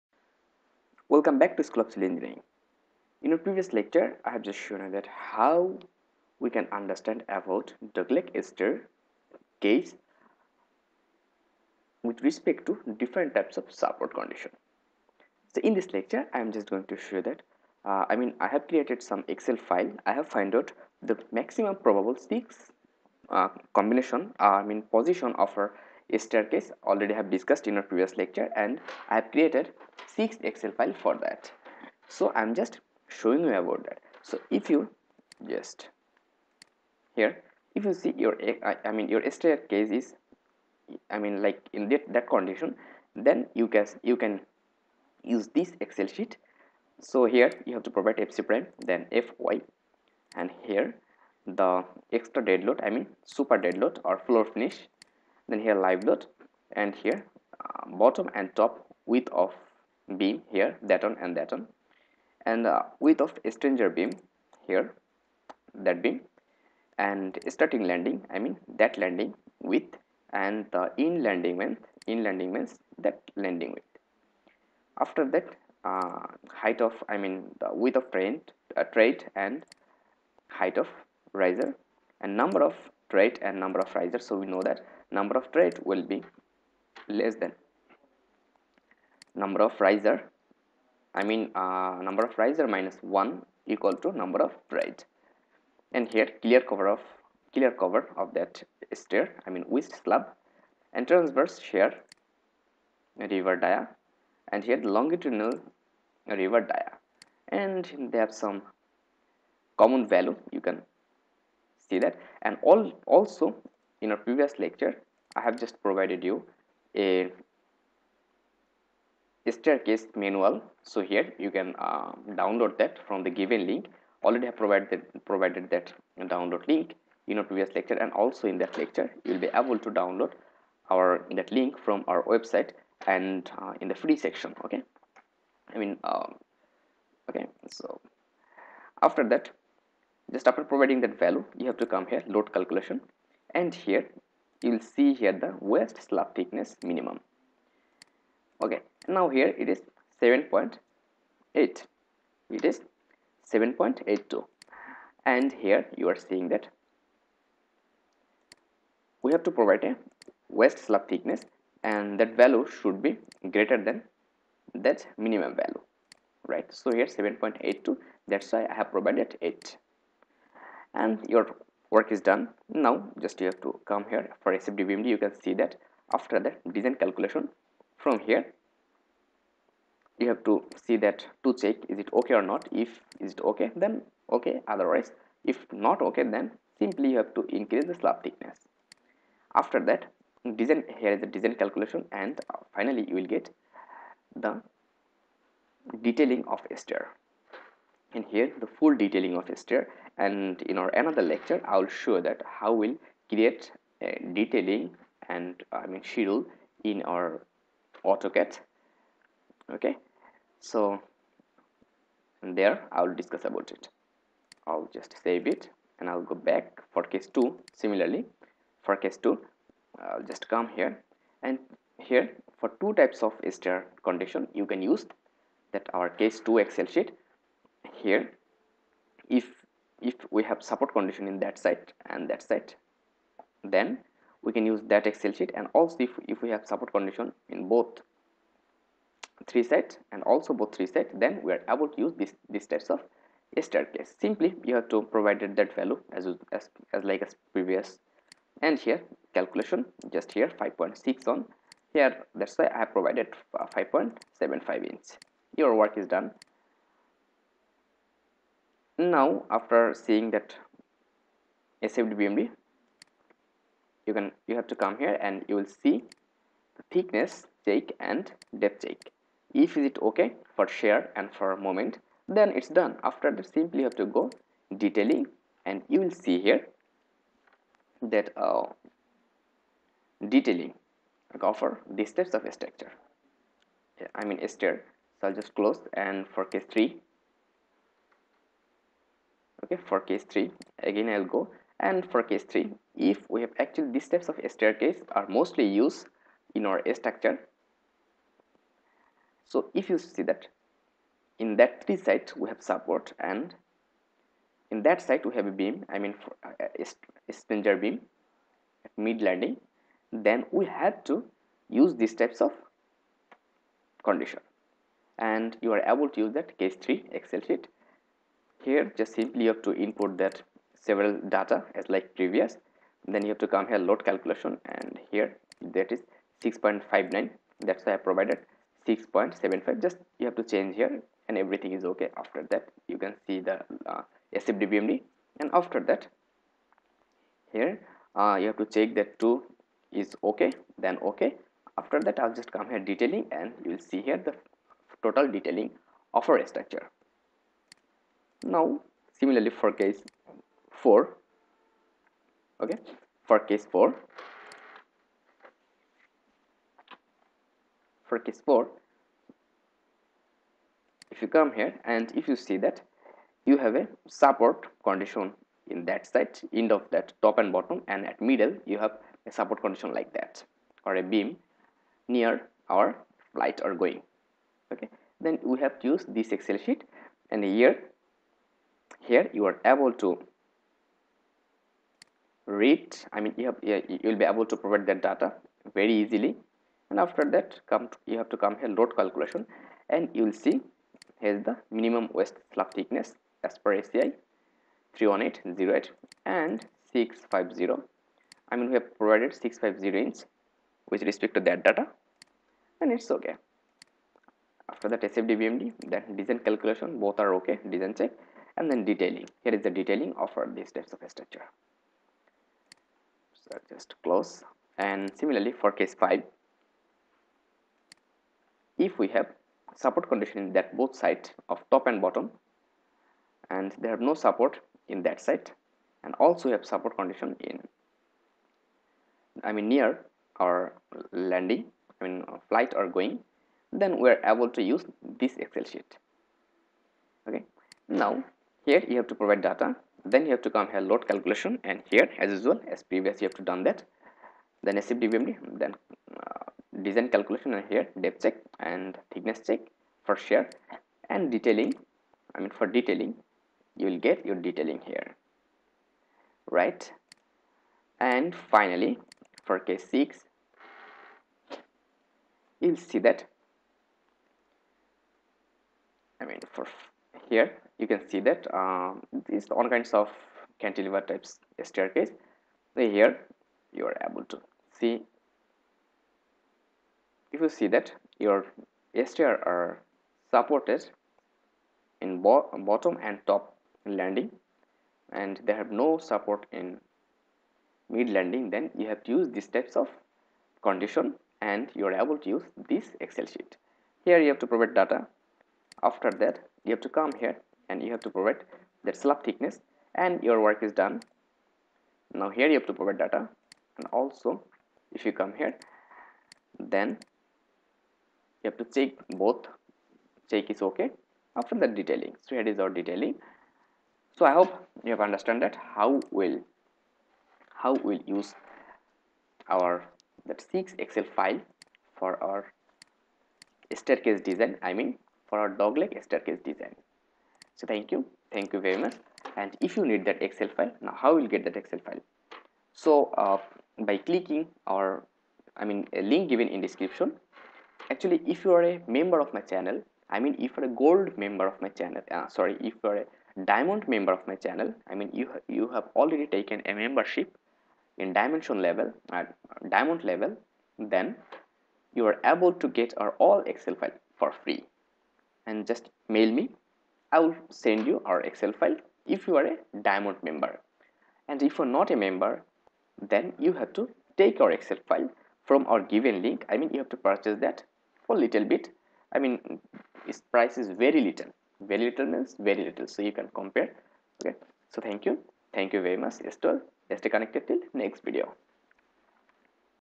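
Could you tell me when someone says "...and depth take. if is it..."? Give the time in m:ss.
4:27.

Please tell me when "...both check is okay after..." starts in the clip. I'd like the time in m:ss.
8:29.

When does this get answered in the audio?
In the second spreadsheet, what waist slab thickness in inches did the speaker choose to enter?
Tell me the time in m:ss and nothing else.
4:13.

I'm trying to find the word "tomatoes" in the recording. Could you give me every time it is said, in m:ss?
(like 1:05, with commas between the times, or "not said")
not said.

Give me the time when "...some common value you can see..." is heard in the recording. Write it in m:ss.
1:48.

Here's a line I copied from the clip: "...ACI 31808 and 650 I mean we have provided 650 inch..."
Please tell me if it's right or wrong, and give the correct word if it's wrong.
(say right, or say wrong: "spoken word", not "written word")
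right.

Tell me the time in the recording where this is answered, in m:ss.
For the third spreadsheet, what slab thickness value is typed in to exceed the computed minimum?
5:27.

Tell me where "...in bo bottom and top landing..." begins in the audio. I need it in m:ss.
8:02.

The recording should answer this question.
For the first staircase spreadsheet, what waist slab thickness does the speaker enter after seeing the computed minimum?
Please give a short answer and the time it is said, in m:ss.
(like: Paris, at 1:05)
8, at 2:48.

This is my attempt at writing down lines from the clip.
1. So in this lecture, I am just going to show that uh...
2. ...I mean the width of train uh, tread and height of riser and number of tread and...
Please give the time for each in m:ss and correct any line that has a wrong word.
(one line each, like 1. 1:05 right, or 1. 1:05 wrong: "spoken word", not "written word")
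1. 0:15 right
2. 1:17 right.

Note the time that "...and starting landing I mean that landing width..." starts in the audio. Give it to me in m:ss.
1:06.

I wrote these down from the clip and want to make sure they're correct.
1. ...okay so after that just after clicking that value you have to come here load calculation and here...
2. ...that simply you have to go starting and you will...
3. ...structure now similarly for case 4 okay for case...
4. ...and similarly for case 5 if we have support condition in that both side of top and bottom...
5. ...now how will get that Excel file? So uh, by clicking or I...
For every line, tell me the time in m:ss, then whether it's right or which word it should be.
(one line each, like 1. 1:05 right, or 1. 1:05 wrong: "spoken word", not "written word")
1. 2:17 wrong: "providing", not "clicking"
2. 4:33 wrong: "detailing", not "starting"
3. 5:46 right
4. 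6:54 right
5. 8:50 right.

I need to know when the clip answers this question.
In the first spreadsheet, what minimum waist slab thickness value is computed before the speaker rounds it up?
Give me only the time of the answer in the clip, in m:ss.
2:31.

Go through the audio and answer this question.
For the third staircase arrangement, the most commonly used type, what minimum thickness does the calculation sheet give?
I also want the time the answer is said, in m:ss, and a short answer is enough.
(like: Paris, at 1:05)
6.59, at 5:25.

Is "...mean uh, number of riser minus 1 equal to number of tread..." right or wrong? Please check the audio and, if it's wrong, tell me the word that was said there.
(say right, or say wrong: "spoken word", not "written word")
right.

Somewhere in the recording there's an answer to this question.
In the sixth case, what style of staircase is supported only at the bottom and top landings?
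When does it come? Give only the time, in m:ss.
7:50.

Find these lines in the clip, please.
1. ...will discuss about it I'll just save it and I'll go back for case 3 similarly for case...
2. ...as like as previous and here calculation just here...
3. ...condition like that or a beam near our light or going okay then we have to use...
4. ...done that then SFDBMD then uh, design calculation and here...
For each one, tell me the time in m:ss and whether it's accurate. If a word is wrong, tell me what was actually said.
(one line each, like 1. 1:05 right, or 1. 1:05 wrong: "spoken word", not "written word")
1. 3:33 wrong: "2", not "3"
2. 4:06 right
3. 6:09 right
4. 7:23 right.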